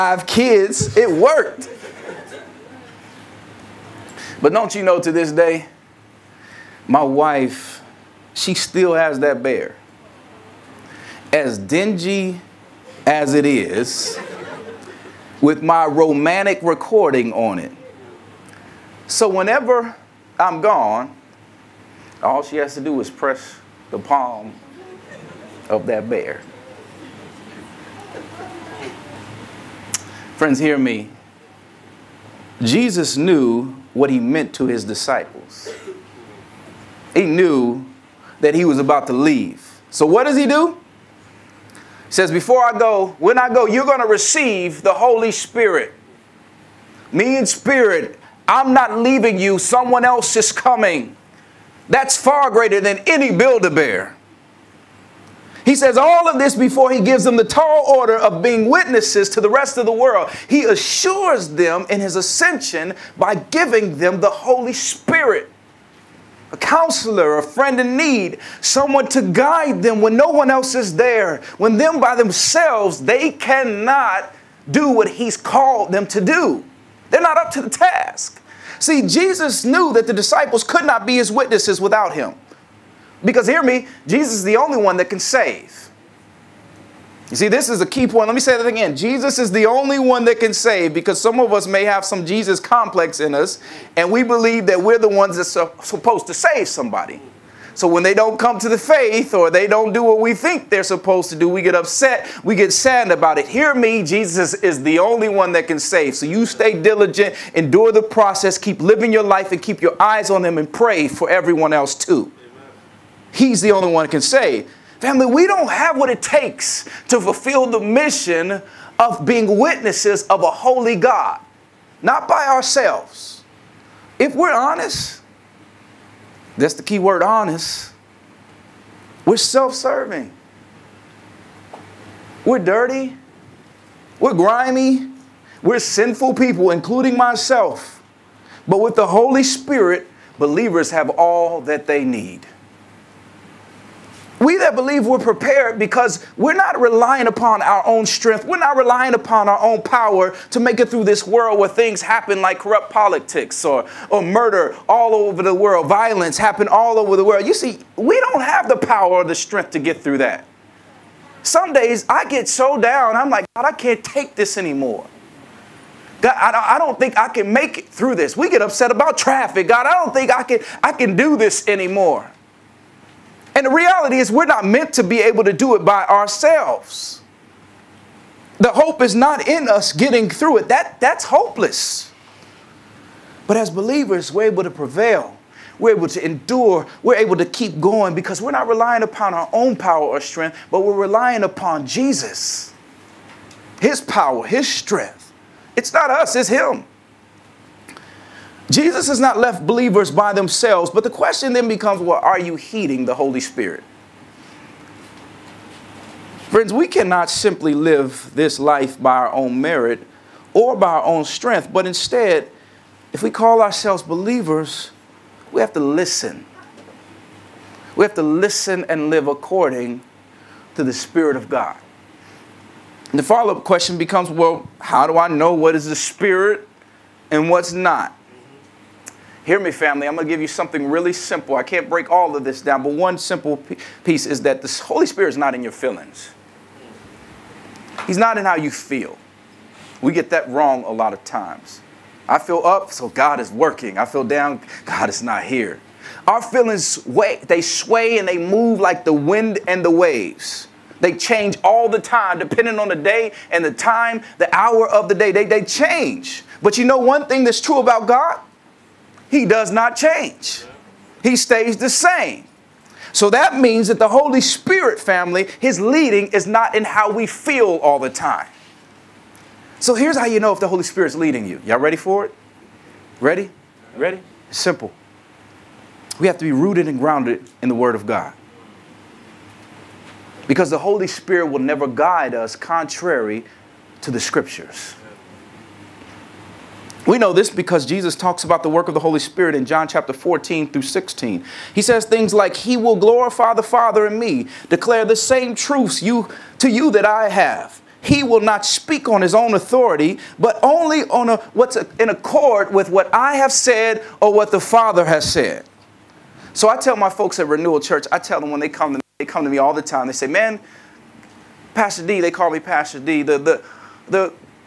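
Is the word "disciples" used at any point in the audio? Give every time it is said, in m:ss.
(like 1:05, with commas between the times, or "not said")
0:34, 1:20.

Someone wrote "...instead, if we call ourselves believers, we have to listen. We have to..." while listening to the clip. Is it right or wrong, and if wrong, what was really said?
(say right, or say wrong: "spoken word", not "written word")
right.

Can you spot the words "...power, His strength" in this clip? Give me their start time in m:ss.
3:14.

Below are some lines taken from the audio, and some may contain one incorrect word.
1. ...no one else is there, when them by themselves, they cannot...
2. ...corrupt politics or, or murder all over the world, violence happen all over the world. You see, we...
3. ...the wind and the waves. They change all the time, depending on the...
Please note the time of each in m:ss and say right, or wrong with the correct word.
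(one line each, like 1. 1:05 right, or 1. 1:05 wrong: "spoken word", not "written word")
1. 1:10 right
2. 2:32 right
3. 4:09 right.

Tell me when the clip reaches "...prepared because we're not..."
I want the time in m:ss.
2:25.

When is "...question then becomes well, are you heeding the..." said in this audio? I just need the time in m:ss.
3:21.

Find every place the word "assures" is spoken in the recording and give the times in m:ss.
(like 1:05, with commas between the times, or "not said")
1:00.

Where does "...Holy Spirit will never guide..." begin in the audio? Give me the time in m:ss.
4:40.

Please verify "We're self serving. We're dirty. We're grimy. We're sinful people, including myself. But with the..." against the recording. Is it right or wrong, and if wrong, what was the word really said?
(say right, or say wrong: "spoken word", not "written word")
right.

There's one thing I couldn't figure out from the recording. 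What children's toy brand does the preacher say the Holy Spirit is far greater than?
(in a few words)
Build-A-Bear.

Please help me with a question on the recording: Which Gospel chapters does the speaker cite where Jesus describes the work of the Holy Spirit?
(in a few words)
John 14 through 16.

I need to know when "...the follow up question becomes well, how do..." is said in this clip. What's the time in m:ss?
3:43.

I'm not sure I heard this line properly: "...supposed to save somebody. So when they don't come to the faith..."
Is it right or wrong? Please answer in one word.
right.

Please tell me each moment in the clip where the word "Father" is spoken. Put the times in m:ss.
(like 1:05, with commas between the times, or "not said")
4:53, 5:04.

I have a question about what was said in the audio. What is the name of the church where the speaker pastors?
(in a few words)
Renewal Church.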